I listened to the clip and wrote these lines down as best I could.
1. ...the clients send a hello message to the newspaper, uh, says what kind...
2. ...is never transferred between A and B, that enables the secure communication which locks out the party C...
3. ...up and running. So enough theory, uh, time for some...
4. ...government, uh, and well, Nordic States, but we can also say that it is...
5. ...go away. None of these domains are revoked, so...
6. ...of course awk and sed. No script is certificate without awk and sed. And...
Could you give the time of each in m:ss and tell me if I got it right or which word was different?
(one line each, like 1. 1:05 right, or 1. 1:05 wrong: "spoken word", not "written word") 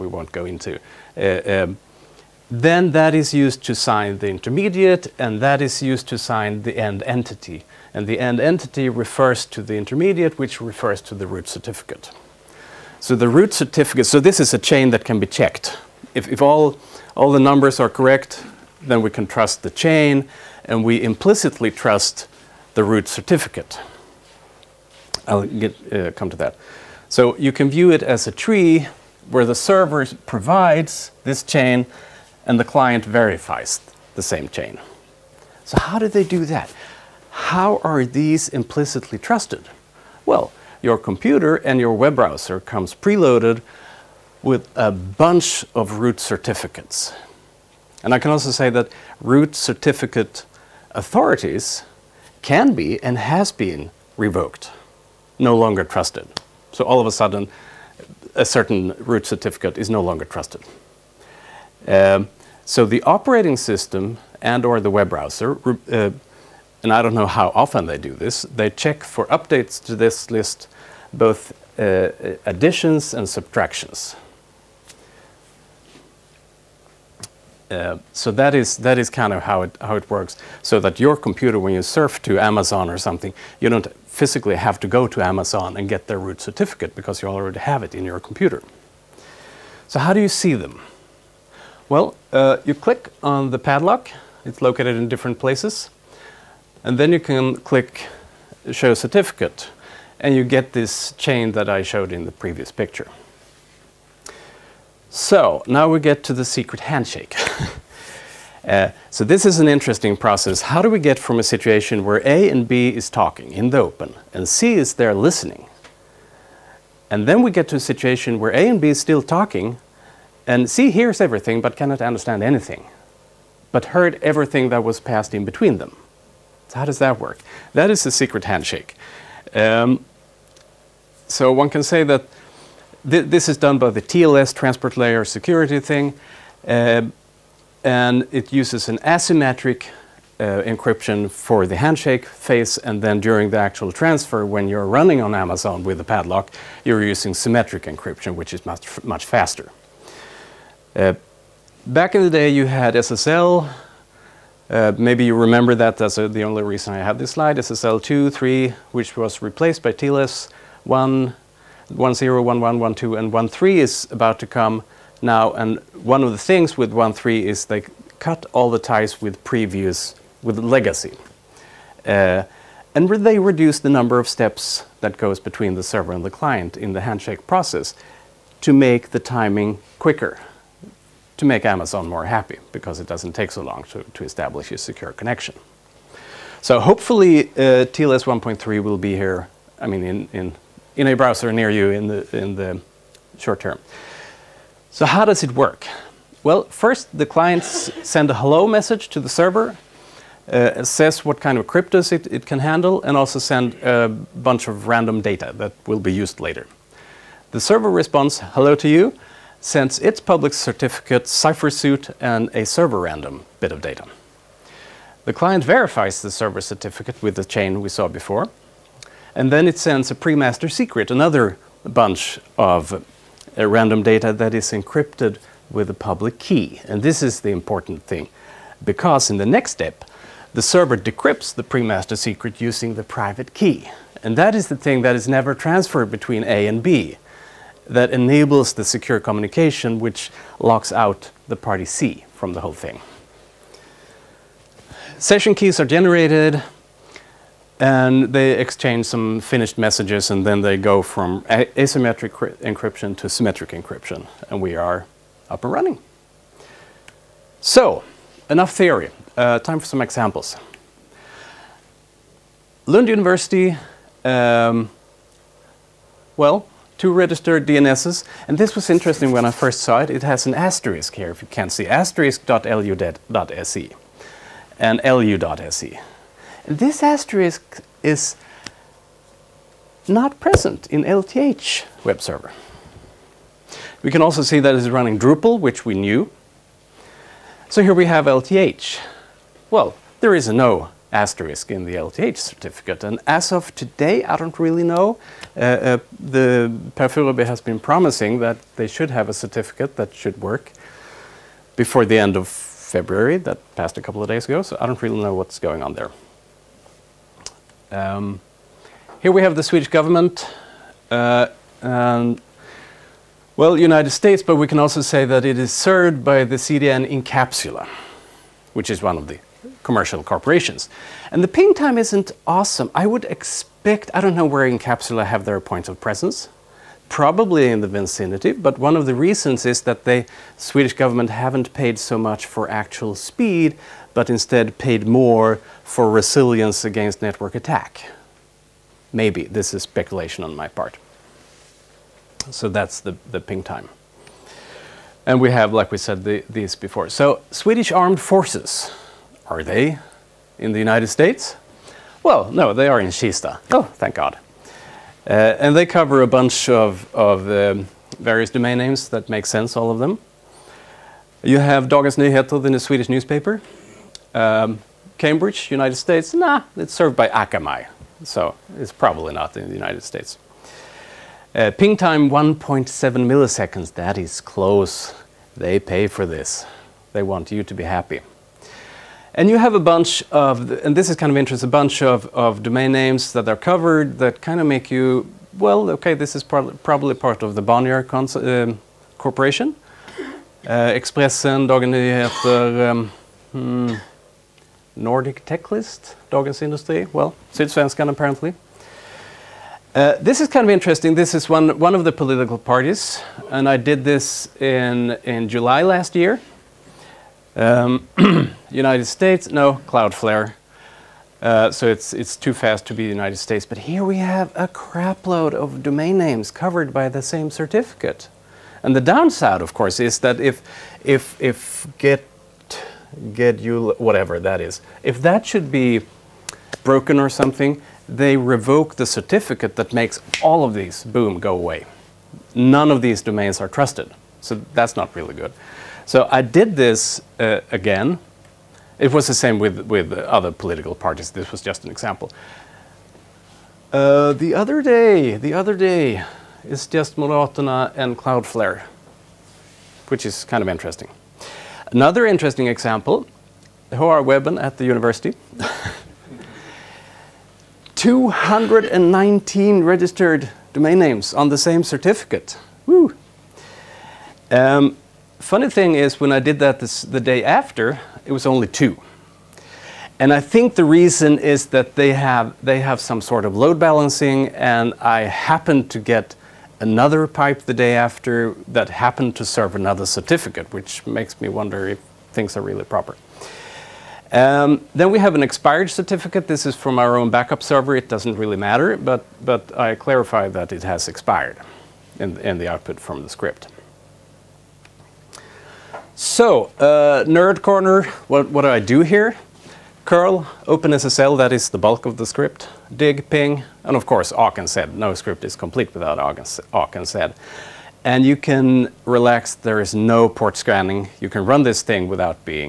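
1. 3:17 wrong: "server", not "newspaper"
2. 3:55 right
3. 4:15 right
4. 5:09 wrong: "United", not "Nordic"
5. 7:11 wrong: "trusted", not "revoked"
6. 8:23 wrong: "complete", not "certificate".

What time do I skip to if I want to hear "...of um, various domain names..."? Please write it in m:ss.
5:57.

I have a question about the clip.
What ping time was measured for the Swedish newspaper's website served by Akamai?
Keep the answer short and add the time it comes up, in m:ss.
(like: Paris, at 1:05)
1.7 milliseconds, at 6:12.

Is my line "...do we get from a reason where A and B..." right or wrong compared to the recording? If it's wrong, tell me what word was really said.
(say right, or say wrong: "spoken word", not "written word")
wrong: "situation", not "reason".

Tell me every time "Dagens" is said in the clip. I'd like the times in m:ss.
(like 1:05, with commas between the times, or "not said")
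6:01, 6:31, 6:36.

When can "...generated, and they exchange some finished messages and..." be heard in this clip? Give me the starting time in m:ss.
4:05.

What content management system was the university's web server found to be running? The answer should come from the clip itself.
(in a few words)
Drupal.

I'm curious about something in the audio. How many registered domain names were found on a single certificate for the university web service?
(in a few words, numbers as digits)
219.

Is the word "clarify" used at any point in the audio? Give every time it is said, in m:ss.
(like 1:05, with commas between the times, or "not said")
8:09.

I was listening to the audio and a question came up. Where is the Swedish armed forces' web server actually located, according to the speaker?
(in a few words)
Kista.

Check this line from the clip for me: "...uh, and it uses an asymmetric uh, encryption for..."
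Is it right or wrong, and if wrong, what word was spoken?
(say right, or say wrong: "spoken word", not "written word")
right.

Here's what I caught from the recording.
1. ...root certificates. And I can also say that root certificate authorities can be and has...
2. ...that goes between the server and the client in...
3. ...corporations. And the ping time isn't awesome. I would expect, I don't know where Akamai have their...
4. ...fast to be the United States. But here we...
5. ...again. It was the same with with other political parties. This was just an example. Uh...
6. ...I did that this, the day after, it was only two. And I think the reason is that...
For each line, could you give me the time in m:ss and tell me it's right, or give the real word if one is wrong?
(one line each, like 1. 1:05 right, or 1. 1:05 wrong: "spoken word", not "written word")
1. 0:45 right
2. 2:54 right
3. 5:20 wrong: "Incapsula", not "Akamai"
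4. 6:52 right
5. 7:17 right
6. 7:46 right.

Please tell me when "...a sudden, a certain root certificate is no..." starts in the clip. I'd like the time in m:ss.
0:57.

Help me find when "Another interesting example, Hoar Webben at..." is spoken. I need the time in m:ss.
7:31.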